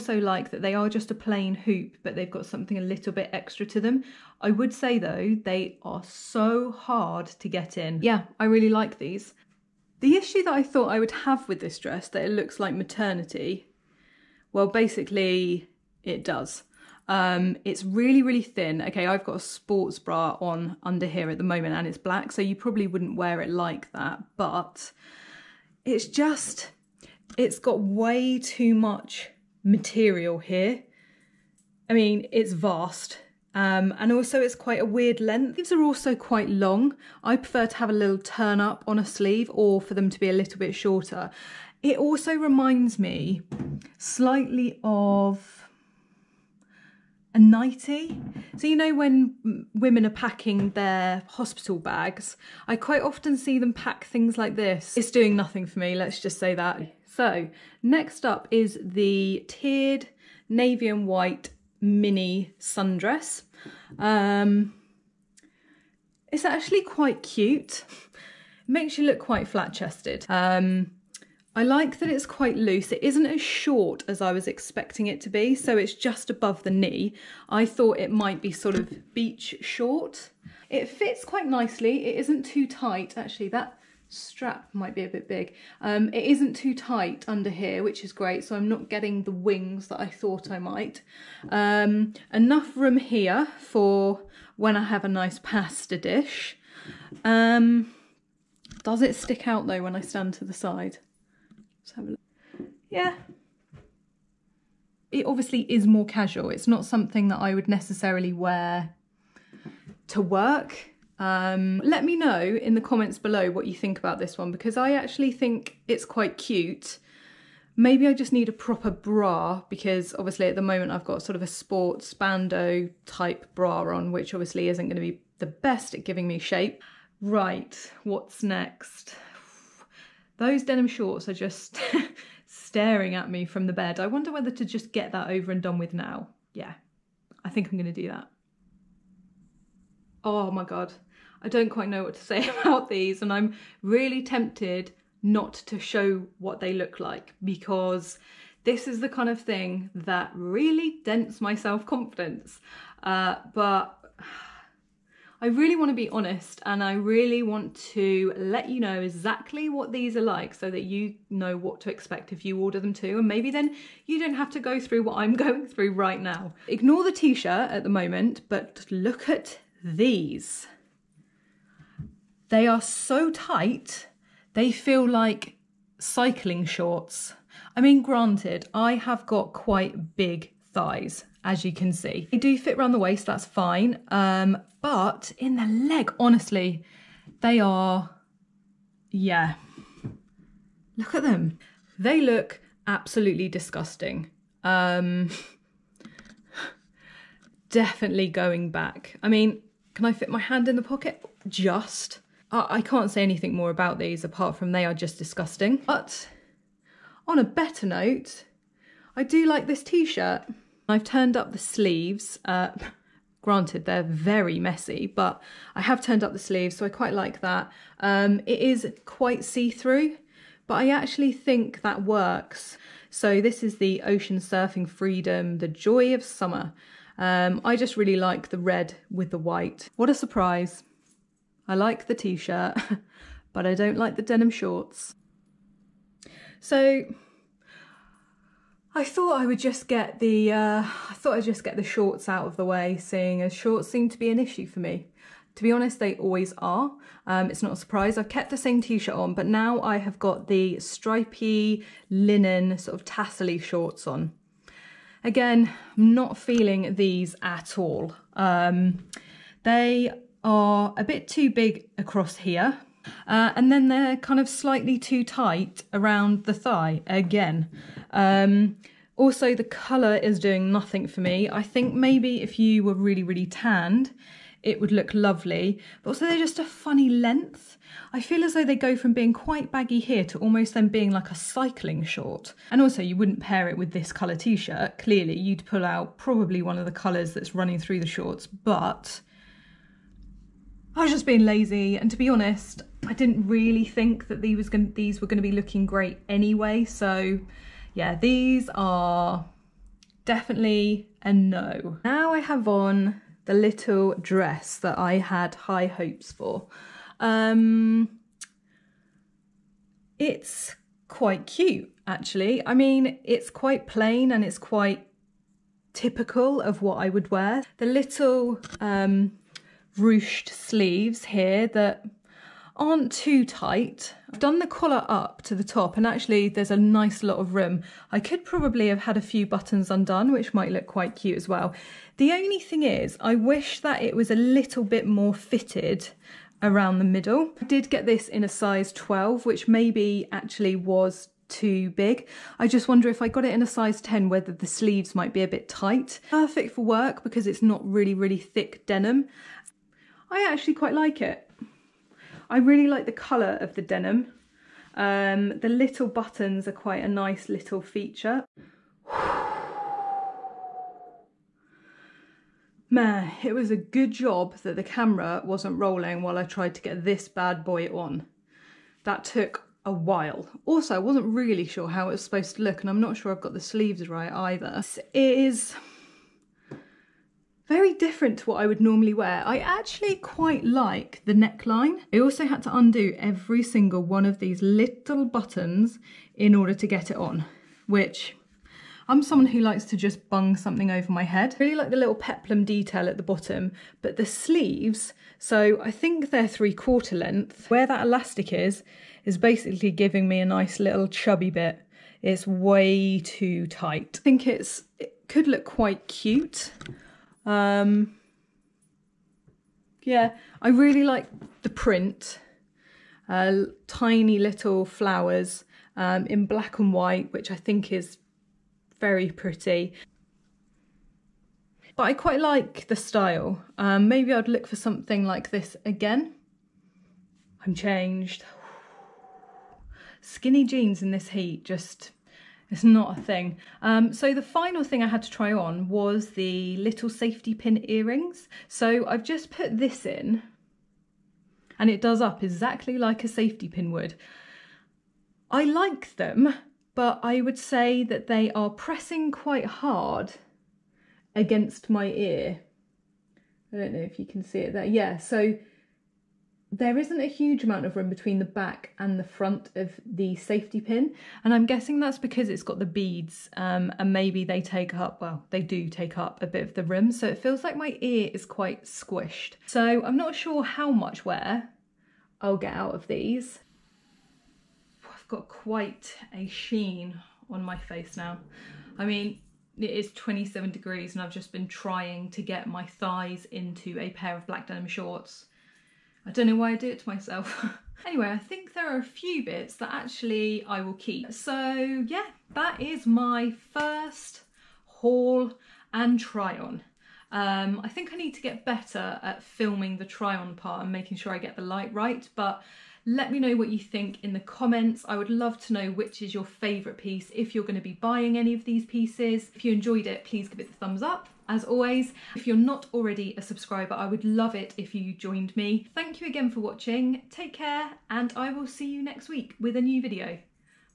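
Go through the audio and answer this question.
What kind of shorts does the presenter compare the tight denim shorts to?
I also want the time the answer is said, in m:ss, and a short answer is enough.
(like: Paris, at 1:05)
Cycling shorts, at 2:55.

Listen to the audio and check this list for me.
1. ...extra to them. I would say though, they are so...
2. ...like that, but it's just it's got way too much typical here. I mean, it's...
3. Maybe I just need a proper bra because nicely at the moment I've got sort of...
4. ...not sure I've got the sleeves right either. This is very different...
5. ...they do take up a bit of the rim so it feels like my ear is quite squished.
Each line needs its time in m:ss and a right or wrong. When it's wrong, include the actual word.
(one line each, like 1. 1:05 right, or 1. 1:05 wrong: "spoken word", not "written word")
1. 0:03 right
2. 0:23 wrong: "material", not "typical"
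3. 1:57 wrong: "obviously", not "nicely"
4. 6:13 right
5. 7:45 right.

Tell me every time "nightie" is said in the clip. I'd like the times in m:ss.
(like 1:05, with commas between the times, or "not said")
0:47.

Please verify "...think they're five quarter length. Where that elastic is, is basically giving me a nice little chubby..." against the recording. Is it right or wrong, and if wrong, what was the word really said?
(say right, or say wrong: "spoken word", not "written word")
wrong: "three", not "five".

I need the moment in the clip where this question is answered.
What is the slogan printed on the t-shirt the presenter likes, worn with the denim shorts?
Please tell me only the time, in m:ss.
3:44.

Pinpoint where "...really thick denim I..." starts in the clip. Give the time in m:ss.
5:48.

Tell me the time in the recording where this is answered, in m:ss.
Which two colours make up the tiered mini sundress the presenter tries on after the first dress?
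1:00.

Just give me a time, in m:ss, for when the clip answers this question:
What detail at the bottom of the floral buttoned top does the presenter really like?
6:32.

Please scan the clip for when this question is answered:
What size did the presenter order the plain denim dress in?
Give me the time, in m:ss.
5:38.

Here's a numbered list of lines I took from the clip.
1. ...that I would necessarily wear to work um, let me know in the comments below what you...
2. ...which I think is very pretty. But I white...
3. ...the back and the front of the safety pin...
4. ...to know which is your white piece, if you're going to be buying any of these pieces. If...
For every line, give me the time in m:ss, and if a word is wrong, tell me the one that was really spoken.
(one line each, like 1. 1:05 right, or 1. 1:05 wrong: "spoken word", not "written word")
1. 1:47 right
2. 6:57 wrong: "quite", not "white"
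3. 7:38 right
4. 8:25 wrong: "favourite", not "white".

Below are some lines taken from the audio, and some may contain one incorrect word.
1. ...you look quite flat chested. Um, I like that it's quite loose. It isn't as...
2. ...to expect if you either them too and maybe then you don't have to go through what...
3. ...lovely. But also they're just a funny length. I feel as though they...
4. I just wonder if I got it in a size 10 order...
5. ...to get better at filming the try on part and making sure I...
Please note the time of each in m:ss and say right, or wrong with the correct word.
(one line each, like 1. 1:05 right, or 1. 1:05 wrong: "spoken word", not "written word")
1. 1:08 right
2. 2:41 wrong: "order", not "either"
3. 4:35 right
4. 5:42 wrong: "whether", not "order"
5. 8:18 right.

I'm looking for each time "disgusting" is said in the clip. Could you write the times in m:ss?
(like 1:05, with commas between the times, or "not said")
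3:13, 3:25.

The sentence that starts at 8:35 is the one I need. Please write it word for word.
Thank you again for watching, take care, and I will see you next week with a new video.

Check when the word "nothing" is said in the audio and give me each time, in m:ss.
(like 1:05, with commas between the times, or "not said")
0:55, 4:30.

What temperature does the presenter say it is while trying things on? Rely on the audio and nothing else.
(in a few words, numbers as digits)
27 degrees.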